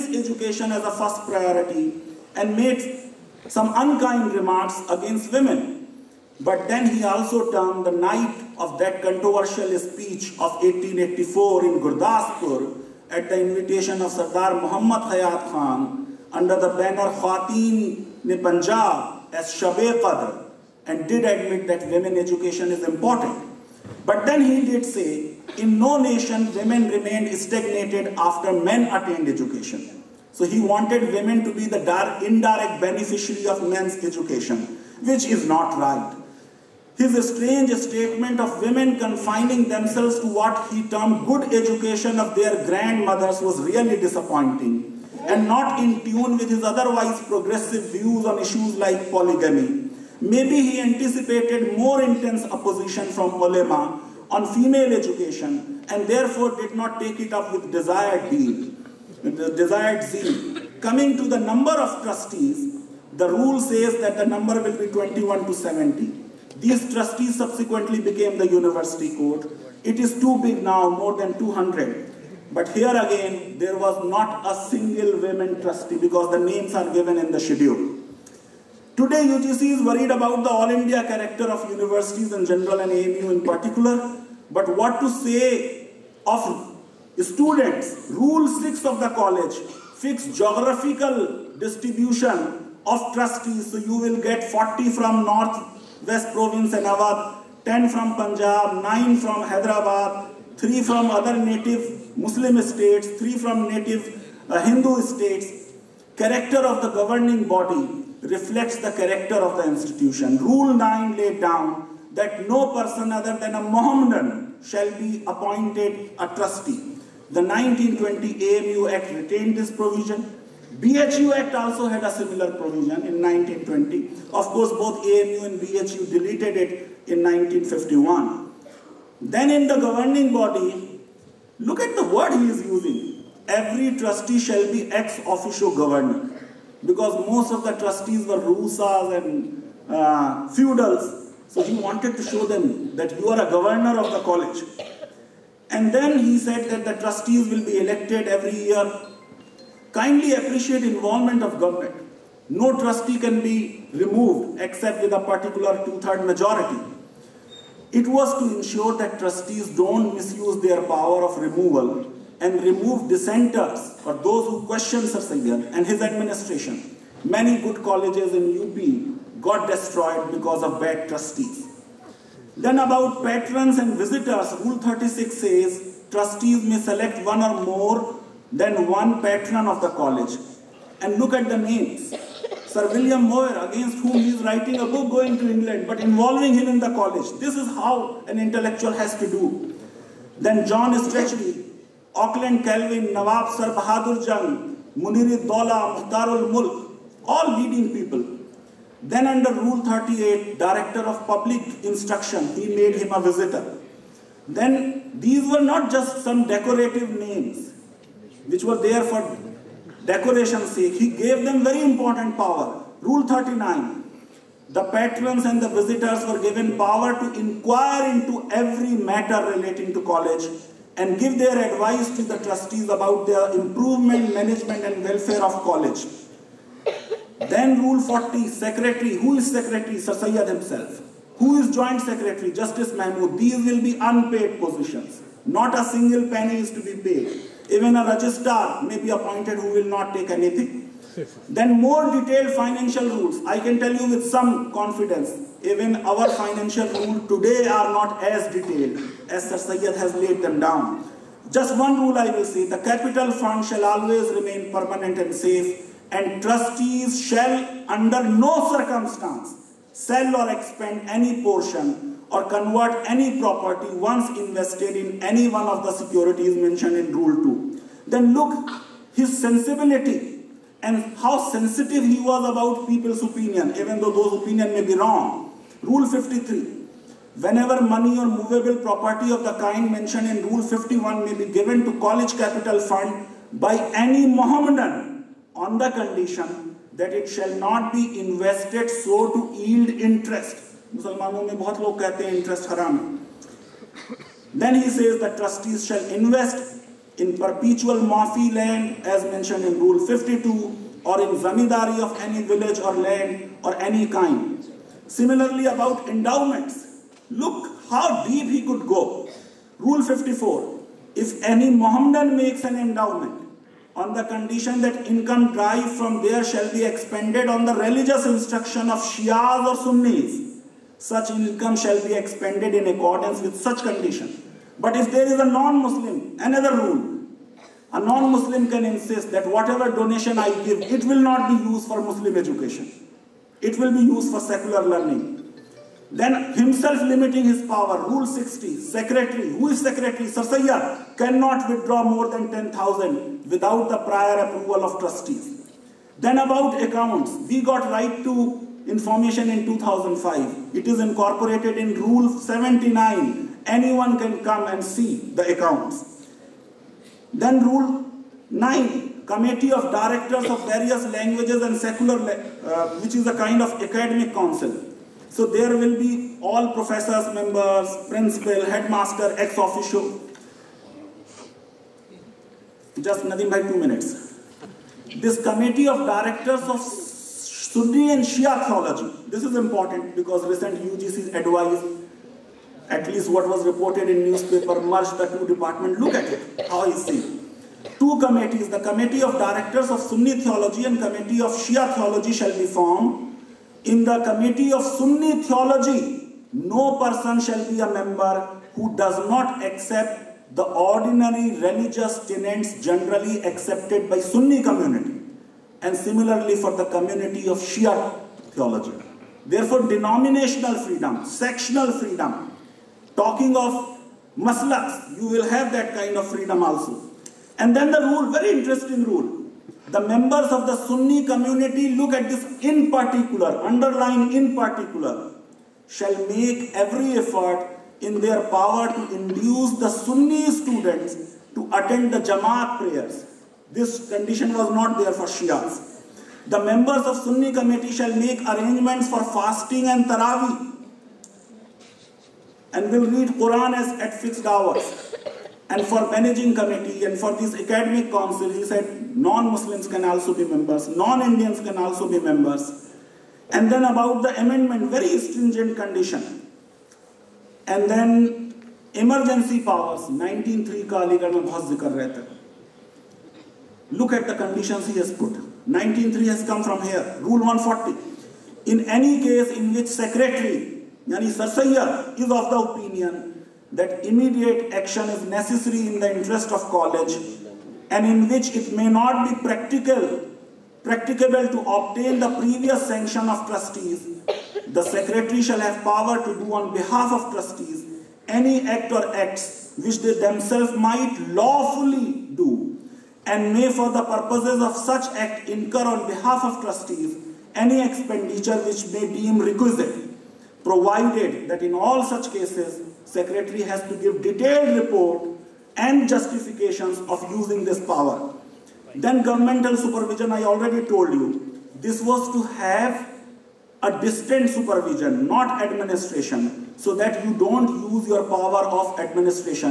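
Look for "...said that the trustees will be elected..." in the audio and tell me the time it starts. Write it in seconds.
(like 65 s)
146 s.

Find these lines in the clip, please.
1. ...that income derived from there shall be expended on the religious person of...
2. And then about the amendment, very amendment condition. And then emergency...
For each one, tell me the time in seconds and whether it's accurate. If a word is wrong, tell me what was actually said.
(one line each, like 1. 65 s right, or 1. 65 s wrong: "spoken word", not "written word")
1. 314 s wrong: "instruction", not "person"
2. 453 s wrong: "stringent", not "amendment".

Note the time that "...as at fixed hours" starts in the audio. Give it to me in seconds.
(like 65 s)
443 s.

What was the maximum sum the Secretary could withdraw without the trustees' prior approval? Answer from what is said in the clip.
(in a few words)
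10,000.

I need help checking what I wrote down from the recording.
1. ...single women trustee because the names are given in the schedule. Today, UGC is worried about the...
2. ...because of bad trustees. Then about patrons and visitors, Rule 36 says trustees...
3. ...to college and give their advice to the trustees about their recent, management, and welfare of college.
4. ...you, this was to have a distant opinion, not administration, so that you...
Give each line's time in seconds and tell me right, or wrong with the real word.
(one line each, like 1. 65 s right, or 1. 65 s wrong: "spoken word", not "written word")
1. 74 s right
2. 170 s right
3. 219 s wrong: "improvement", not "recent"
4. 511 s wrong: "supervision", not "opinion".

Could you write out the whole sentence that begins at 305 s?
Similarly, about endowments, look how deep he could go.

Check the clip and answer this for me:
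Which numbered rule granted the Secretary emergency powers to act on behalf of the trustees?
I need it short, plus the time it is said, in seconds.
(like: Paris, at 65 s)
Rule 140, at 467 s.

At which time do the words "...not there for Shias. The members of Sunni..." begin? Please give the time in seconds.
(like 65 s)
434 s.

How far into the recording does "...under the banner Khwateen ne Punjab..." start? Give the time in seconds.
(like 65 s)
16 s.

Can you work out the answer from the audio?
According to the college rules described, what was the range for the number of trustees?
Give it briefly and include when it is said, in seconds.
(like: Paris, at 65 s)
21 to 70, at 64 s.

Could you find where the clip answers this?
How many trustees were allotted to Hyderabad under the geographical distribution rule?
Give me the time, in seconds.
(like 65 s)
98 s.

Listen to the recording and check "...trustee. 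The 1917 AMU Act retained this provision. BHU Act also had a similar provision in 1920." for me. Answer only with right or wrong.
wrong.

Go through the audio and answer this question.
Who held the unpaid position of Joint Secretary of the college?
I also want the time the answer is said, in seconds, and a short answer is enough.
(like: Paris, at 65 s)
Justice Mahmood, at 232 s.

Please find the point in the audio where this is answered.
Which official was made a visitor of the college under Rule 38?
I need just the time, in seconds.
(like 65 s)
200 s.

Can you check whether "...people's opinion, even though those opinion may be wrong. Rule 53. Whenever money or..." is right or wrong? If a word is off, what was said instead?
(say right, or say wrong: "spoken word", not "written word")
right.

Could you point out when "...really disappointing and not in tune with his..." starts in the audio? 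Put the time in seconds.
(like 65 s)
43 s.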